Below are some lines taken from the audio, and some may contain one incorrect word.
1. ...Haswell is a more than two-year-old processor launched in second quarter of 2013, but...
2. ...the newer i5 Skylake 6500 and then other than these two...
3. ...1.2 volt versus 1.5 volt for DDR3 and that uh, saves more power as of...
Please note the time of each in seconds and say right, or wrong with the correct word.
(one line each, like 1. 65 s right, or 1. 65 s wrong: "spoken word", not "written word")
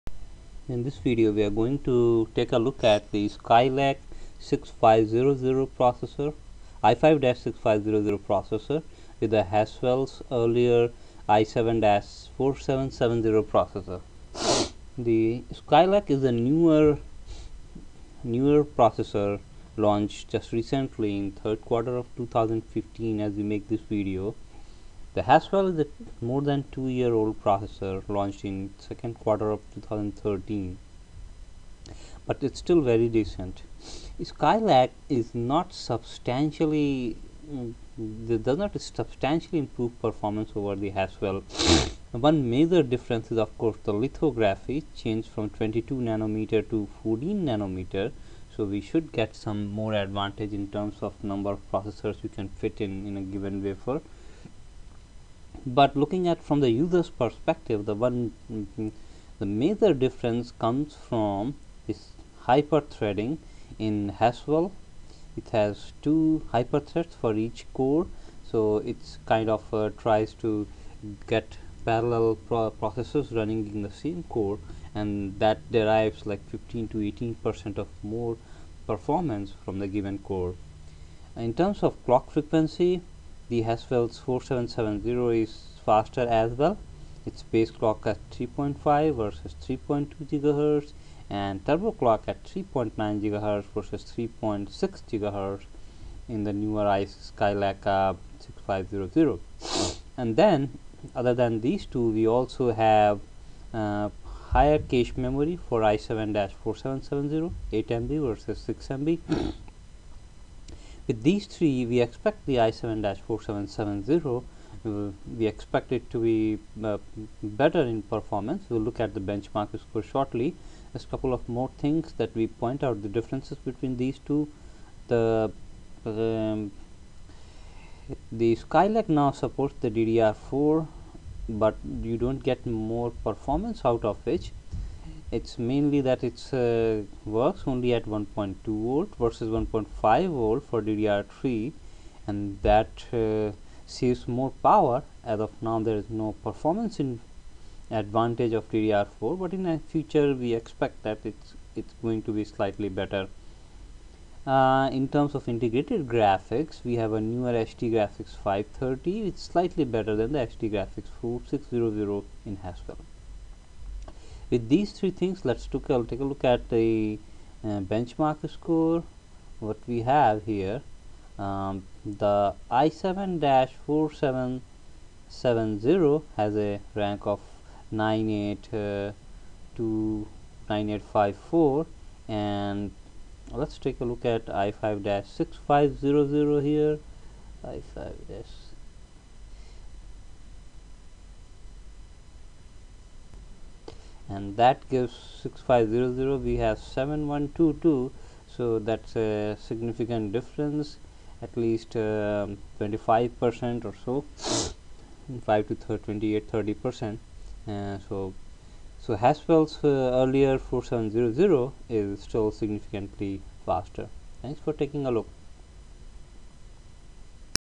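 1. 25 s right
2. 96 s right
3. 138 s right.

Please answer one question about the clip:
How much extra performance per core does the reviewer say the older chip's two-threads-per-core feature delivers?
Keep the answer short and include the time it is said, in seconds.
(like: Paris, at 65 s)
15 to 18 percent, at 76 s.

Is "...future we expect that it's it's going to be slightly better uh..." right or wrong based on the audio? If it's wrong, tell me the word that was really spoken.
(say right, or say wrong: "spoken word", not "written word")
right.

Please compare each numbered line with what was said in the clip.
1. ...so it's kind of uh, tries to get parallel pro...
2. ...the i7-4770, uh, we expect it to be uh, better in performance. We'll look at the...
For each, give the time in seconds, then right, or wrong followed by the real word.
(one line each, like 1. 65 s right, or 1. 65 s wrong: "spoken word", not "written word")
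1. 68 s right
2. 112 s right.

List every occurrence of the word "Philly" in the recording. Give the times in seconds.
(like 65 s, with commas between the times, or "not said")
not said.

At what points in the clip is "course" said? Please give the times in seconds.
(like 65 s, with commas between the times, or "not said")
43 s.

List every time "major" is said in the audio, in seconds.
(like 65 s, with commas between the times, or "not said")
42 s, 59 s.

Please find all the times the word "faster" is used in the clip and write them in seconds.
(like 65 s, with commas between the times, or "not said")
85 s, 213 s.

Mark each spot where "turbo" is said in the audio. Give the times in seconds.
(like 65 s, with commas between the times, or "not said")
91 s.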